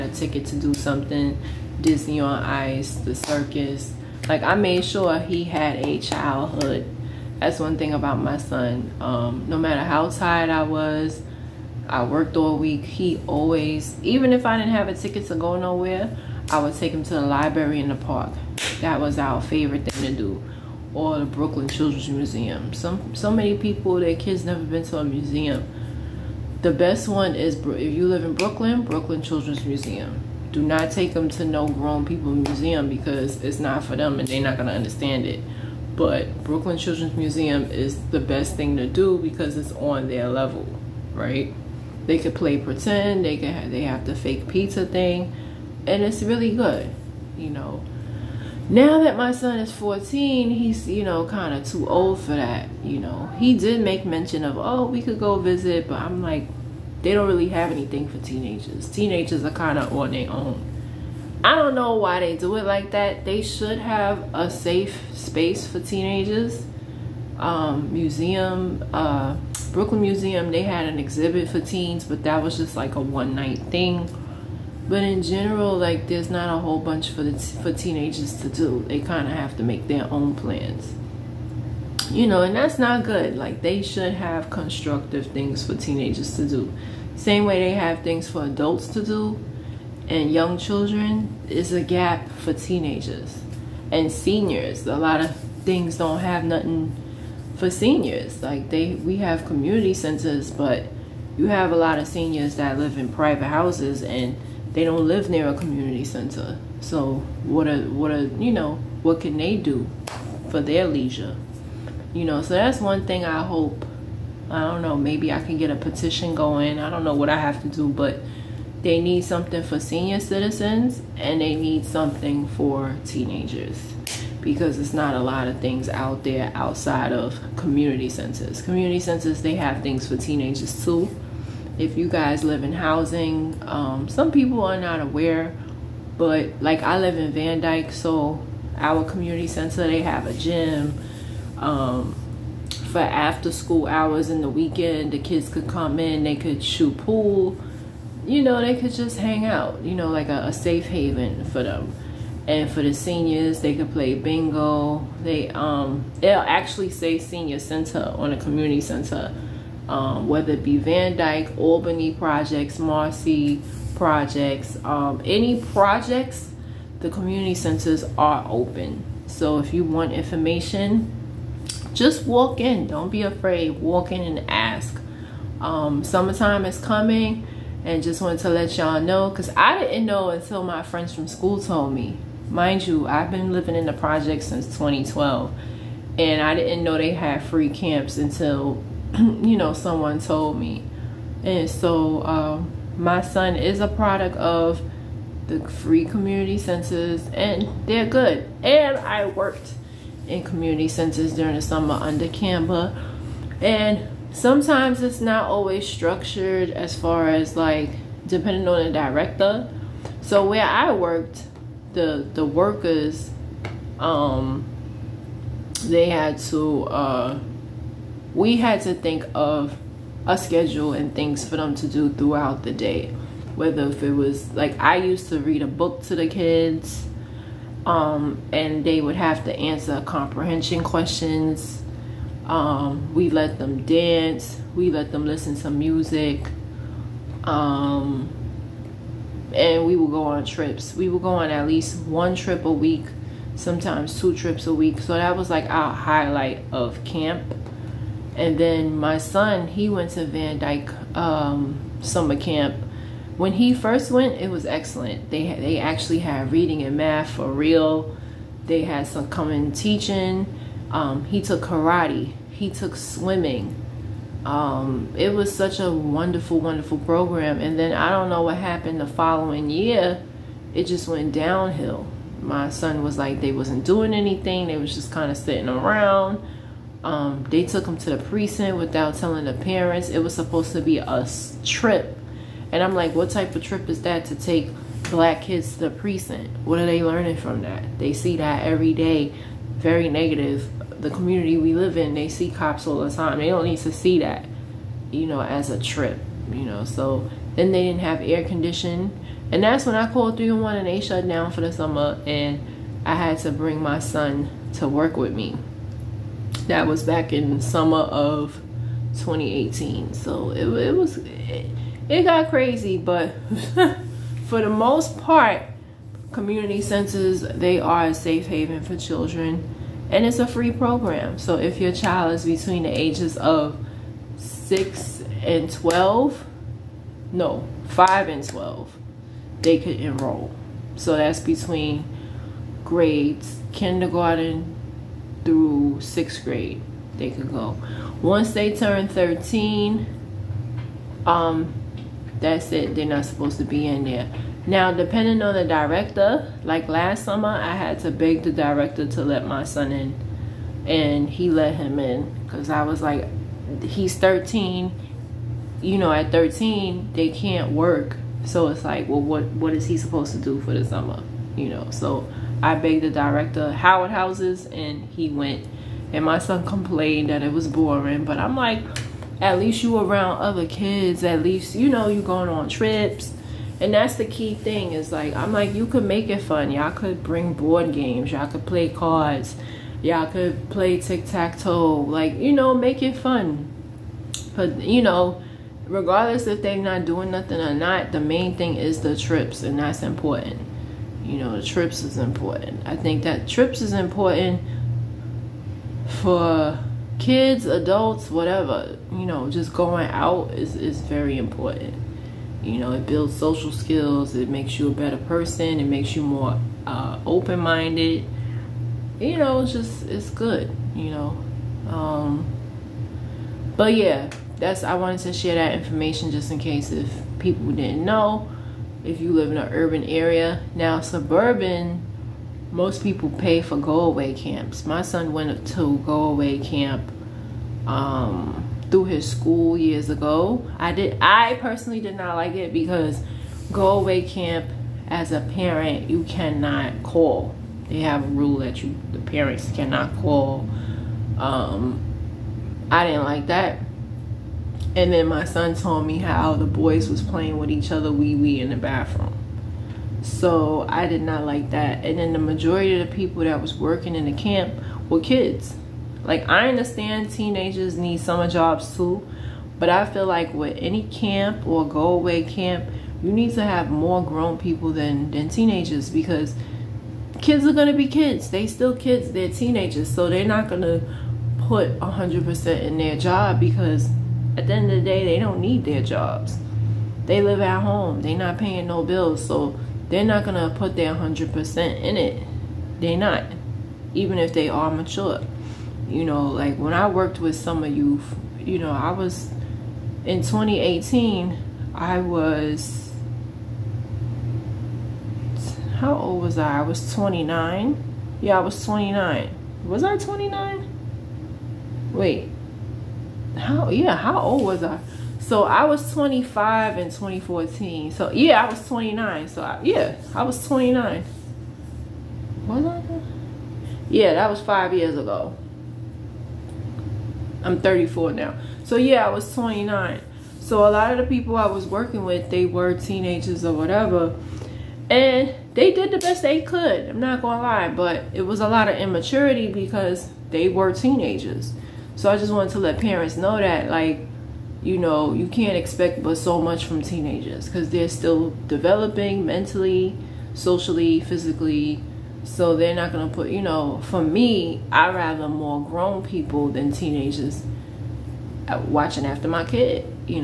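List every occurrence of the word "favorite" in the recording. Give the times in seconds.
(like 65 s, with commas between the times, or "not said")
19 s.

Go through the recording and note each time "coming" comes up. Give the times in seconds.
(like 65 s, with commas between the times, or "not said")
176 s, 259 s.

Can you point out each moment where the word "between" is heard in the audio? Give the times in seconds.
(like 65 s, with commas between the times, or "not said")
322 s, 331 s.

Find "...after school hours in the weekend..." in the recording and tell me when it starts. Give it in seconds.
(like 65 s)
142 s.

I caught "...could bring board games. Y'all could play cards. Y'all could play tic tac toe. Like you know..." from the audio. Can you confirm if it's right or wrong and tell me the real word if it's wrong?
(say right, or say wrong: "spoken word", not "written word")
right.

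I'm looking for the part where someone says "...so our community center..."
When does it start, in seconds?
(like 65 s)
137 s.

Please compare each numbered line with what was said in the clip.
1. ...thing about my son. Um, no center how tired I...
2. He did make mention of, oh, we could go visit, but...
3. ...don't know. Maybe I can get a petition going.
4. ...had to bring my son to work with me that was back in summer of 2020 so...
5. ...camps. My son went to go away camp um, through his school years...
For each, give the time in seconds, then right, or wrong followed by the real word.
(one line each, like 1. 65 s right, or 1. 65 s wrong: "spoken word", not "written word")
1. 7 s wrong: "matter", not "center"
2. 53 s right
3. 114 s right
4. 303 s wrong: "2018", not "2020"
5. 424 s right.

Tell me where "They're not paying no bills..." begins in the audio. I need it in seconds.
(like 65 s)
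478 s.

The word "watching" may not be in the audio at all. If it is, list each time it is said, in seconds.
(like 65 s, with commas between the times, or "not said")
548 s.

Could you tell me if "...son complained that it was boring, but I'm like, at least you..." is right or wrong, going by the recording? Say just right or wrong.
right.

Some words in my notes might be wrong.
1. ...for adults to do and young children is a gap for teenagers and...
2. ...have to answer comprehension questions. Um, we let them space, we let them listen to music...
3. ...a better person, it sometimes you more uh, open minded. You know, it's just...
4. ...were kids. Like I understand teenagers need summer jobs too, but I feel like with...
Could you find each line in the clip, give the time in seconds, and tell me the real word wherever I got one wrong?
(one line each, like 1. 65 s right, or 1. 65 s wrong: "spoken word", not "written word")
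1. 88 s right
2. 229 s wrong: "dance", not "space"
3. 404 s wrong: "makes", not "sometimes"
4. 455 s right.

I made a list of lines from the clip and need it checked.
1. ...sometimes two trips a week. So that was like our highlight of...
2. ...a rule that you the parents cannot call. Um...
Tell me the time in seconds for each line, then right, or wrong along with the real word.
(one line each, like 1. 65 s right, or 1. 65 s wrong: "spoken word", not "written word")
1. 243 s right
2. 438 s right.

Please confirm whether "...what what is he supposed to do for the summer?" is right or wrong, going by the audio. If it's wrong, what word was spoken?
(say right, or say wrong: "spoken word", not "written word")
right.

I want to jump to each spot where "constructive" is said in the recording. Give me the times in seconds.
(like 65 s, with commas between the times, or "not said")
84 s.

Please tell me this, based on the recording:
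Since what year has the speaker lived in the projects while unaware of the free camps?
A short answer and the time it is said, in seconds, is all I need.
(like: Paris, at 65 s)
2012, at 184 s.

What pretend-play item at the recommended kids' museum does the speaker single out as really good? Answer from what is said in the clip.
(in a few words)
fake pizza thing.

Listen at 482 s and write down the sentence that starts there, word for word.
They're not, even if they are mature.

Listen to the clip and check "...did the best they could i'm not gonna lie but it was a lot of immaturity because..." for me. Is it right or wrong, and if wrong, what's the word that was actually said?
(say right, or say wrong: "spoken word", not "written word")
right.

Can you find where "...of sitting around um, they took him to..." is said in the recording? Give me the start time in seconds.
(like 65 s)
275 s.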